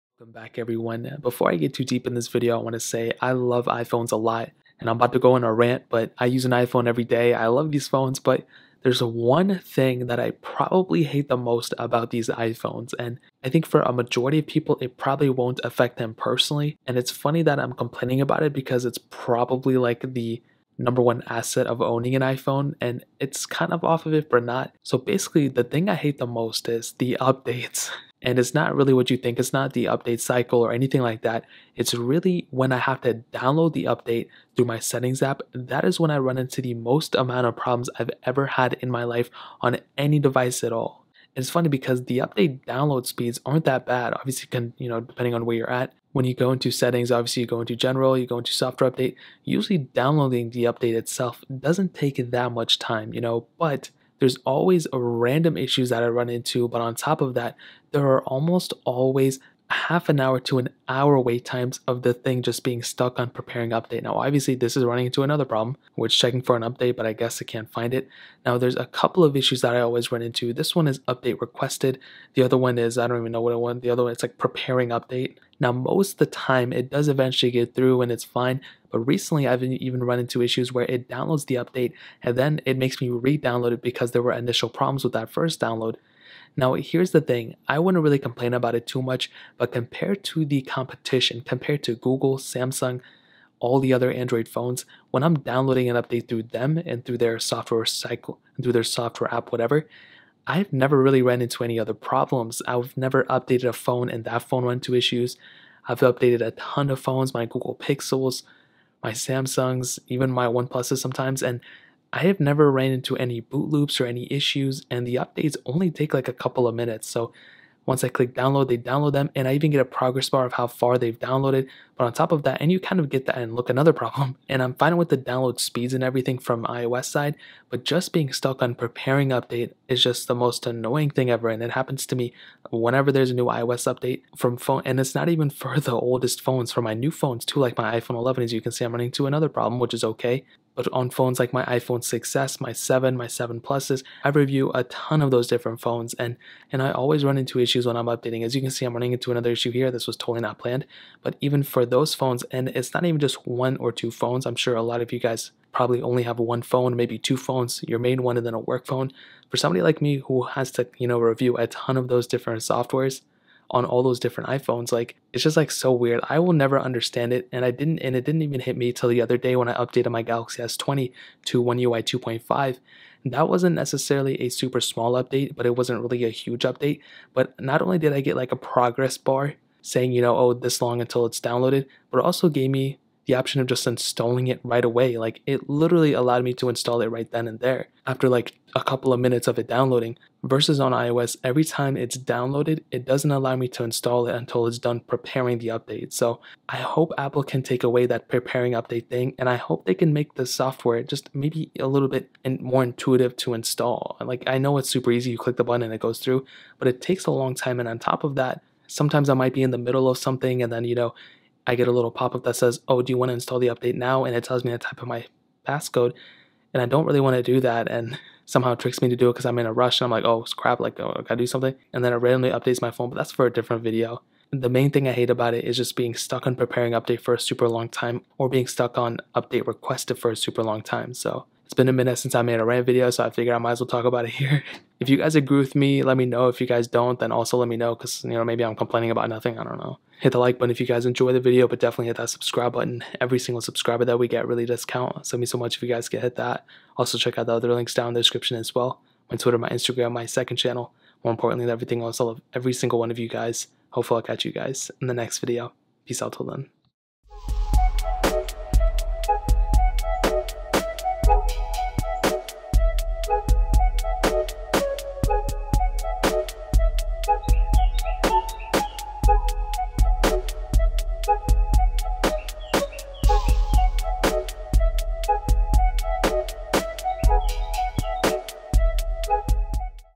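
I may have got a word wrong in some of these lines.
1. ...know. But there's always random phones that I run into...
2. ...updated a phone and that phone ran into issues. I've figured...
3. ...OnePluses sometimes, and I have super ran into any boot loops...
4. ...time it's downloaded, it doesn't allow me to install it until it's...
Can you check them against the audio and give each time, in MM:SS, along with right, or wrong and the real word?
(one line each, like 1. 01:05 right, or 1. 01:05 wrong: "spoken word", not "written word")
1. 00:53 wrong: "issues", not "phones"
2. 01:43 wrong: "updated", not "figured"
3. 01:50 wrong: "never", not "super"
4. 03:11 right.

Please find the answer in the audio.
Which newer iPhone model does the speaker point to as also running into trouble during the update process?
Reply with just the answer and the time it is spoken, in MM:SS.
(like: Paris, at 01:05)
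iPhone 11, at 02:18.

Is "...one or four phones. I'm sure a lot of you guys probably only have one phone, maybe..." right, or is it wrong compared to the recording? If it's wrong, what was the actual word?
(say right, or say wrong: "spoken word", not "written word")
wrong: "two", not "four".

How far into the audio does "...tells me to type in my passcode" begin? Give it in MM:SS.
03:34.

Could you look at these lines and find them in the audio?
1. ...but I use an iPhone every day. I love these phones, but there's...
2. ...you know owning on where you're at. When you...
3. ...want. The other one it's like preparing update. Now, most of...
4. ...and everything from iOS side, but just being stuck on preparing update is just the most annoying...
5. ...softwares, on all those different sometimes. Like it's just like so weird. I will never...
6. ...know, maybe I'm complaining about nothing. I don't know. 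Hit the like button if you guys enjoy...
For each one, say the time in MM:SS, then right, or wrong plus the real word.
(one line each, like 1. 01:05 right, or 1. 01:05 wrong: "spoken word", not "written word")
1. 00:05 right
2. 00:44 wrong: "depending", not "owning"
3. 01:13 right
4. 02:05 right
5. 02:42 wrong: "iPhones", not "sometimes"
6. 03:58 right.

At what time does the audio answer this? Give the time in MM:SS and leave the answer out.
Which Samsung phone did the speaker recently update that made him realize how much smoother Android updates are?
02:50.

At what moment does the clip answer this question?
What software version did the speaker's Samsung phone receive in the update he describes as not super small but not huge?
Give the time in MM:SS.
02:51.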